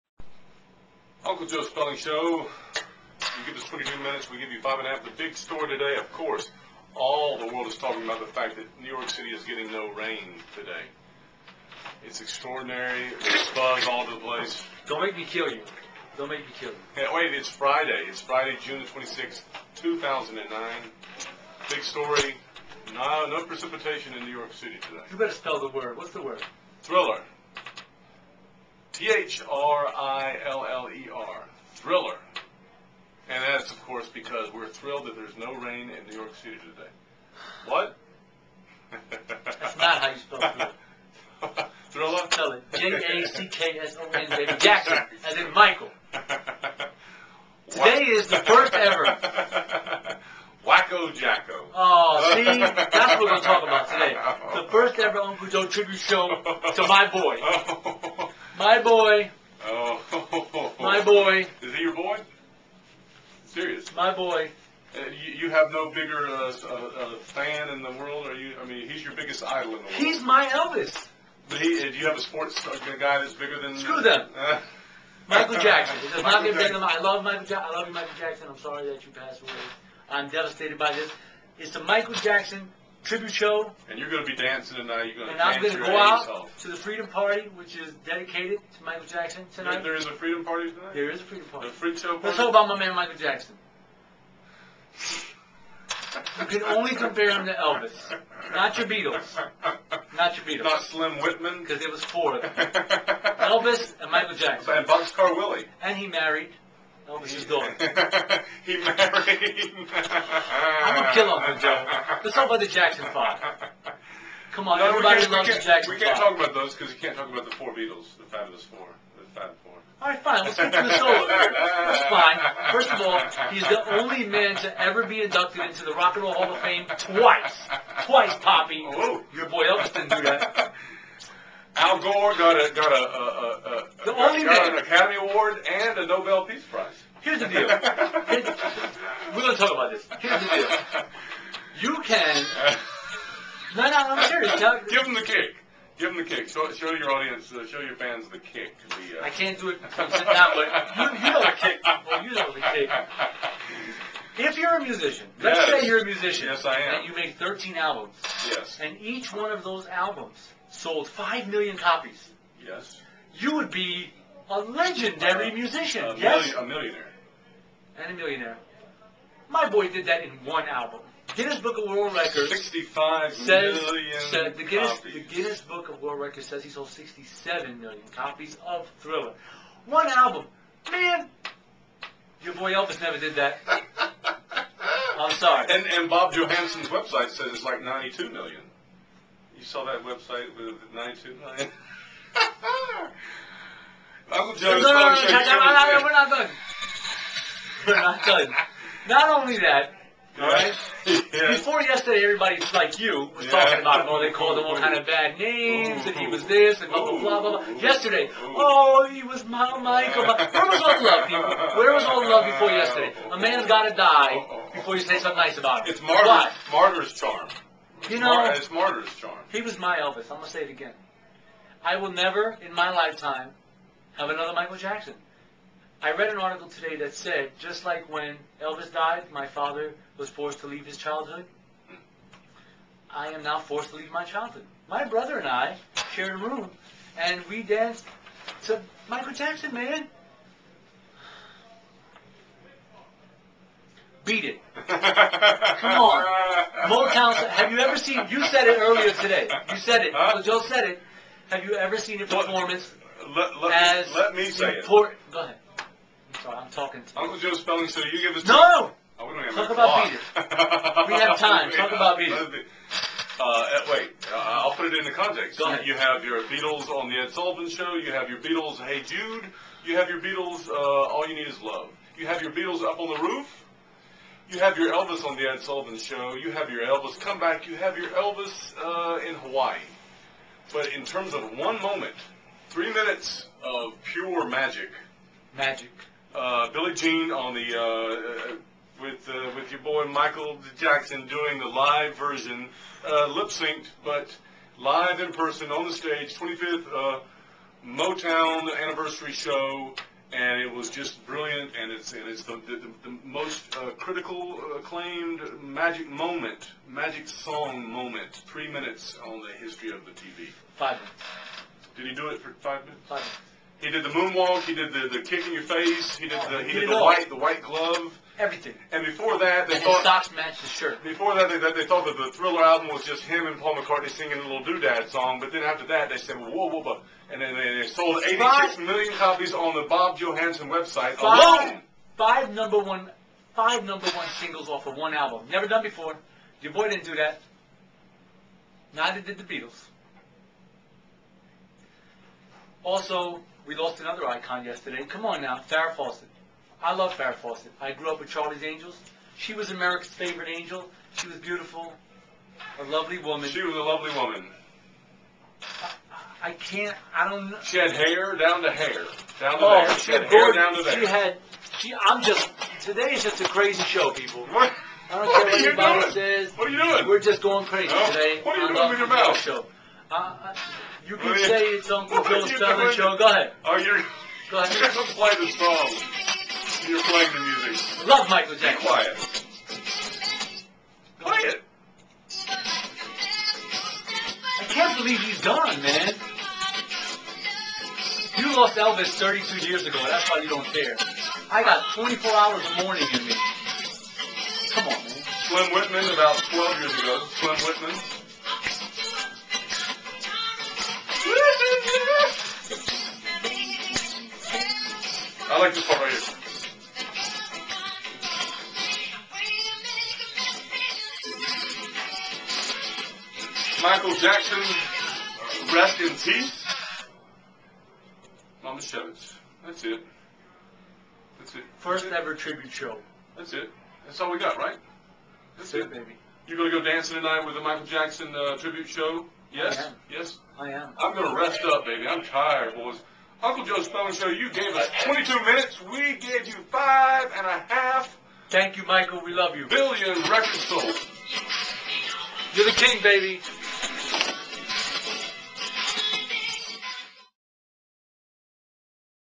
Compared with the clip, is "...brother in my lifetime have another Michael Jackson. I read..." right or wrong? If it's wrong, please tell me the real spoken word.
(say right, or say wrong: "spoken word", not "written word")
wrong: "never", not "brother".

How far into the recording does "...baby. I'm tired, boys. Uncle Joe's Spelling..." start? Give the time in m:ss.
7:11.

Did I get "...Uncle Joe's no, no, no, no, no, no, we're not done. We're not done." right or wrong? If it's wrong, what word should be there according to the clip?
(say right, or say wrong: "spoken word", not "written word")
right.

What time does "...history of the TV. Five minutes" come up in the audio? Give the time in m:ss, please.
5:09.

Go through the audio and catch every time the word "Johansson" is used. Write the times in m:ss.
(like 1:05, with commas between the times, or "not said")
3:06, 5:30.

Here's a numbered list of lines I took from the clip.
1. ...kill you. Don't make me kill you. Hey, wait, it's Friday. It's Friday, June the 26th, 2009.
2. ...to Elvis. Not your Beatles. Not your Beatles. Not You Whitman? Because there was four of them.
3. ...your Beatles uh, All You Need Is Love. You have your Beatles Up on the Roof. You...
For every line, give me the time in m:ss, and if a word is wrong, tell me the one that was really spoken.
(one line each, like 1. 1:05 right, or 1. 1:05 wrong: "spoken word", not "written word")
1. 0:15 right
2. 1:37 wrong: "Slim", not "You"
3. 4:30 right.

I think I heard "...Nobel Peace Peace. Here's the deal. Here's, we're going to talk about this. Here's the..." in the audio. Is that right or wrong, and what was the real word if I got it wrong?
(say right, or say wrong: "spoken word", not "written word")
wrong: "Prize", not "Peace".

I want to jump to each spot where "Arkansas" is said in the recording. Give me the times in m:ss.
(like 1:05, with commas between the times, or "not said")
not said.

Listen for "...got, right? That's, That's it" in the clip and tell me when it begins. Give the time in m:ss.
7:04.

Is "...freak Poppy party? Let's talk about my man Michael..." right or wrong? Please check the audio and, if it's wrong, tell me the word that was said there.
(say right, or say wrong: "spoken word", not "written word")
wrong: "Show", not "Poppy".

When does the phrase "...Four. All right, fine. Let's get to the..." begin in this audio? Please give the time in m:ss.
1:59.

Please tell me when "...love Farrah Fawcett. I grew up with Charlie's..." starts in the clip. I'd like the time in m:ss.
5:46.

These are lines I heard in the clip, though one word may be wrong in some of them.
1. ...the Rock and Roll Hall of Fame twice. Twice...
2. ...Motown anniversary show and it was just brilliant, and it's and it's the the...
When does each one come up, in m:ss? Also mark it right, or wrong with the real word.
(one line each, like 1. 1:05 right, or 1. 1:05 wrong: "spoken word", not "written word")
1. 2:05 right
2. 4:57 right.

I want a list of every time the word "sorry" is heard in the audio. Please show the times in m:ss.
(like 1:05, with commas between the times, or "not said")
1:18, 3:05, 4:16.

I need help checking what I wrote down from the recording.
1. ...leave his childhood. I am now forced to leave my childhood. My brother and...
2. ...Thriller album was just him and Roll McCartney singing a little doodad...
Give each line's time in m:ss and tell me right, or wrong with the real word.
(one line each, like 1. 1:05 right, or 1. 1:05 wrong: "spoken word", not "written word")
1. 3:50 right
2. 5:22 wrong: "Paul", not "Roll".